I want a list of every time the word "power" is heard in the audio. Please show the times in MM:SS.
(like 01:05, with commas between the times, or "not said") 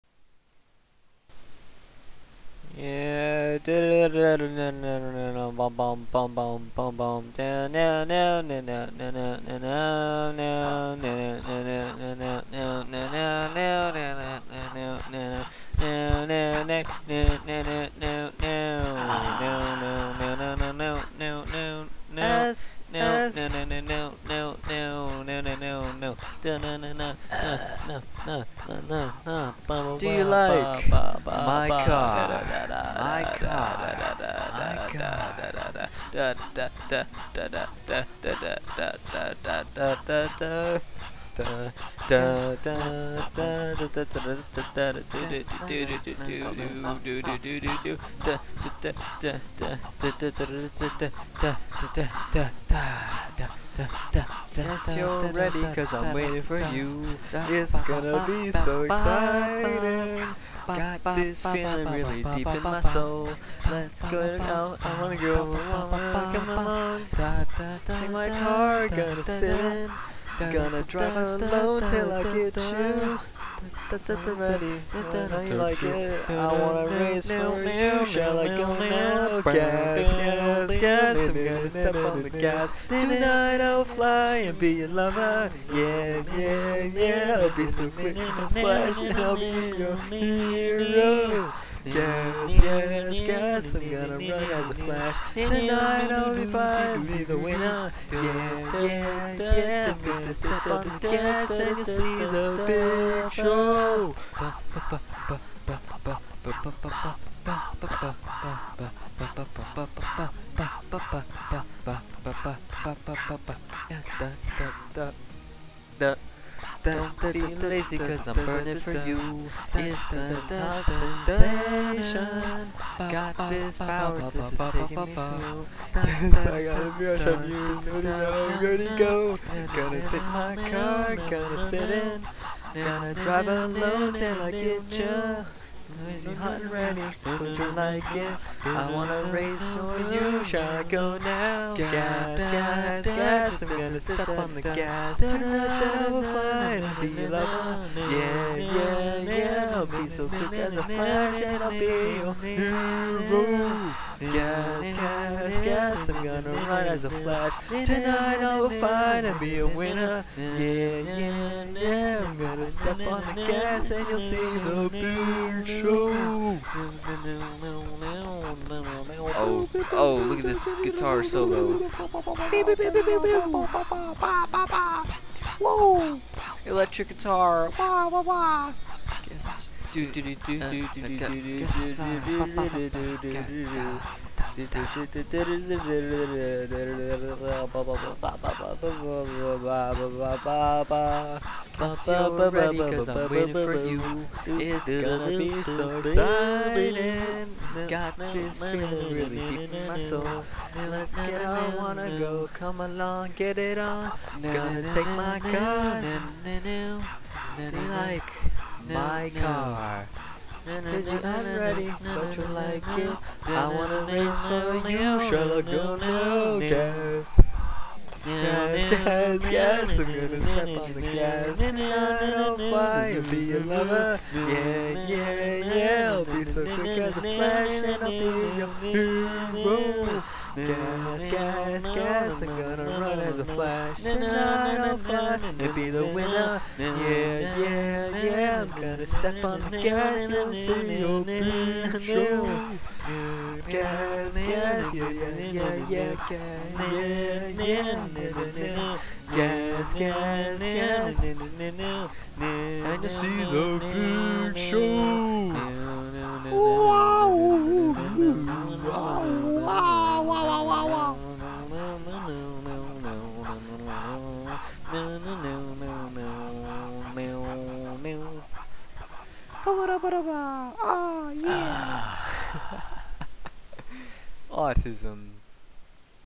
02:03.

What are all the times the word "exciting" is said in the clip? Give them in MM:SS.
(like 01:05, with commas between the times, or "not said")
00:58, 03:15.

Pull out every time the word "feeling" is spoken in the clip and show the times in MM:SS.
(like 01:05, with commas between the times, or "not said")
01:01, 03:18.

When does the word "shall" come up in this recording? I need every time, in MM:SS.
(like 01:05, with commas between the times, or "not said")
01:18, 02:20.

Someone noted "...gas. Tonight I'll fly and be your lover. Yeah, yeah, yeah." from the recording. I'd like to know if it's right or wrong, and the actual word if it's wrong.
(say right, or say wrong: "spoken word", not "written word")
right.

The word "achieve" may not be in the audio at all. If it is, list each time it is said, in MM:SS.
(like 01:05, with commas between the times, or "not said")
not said.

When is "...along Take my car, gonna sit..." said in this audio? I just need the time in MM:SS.
01:06.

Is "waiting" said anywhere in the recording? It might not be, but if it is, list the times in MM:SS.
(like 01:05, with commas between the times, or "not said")
00:56, 03:13.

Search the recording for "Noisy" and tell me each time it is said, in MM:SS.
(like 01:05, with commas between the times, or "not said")
02:15.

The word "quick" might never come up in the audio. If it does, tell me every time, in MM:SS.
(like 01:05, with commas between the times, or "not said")
01:27, 02:30, 03:46.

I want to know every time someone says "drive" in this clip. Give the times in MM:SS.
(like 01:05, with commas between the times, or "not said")
01:10, 02:13.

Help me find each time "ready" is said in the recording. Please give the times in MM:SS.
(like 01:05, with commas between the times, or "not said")
00:55, 01:14, 02:08, 02:16, 03:00, 03:31.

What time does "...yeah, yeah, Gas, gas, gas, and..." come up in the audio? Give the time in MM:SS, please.
04:07.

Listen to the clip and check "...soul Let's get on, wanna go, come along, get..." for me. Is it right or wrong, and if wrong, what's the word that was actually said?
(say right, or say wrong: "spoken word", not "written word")
right.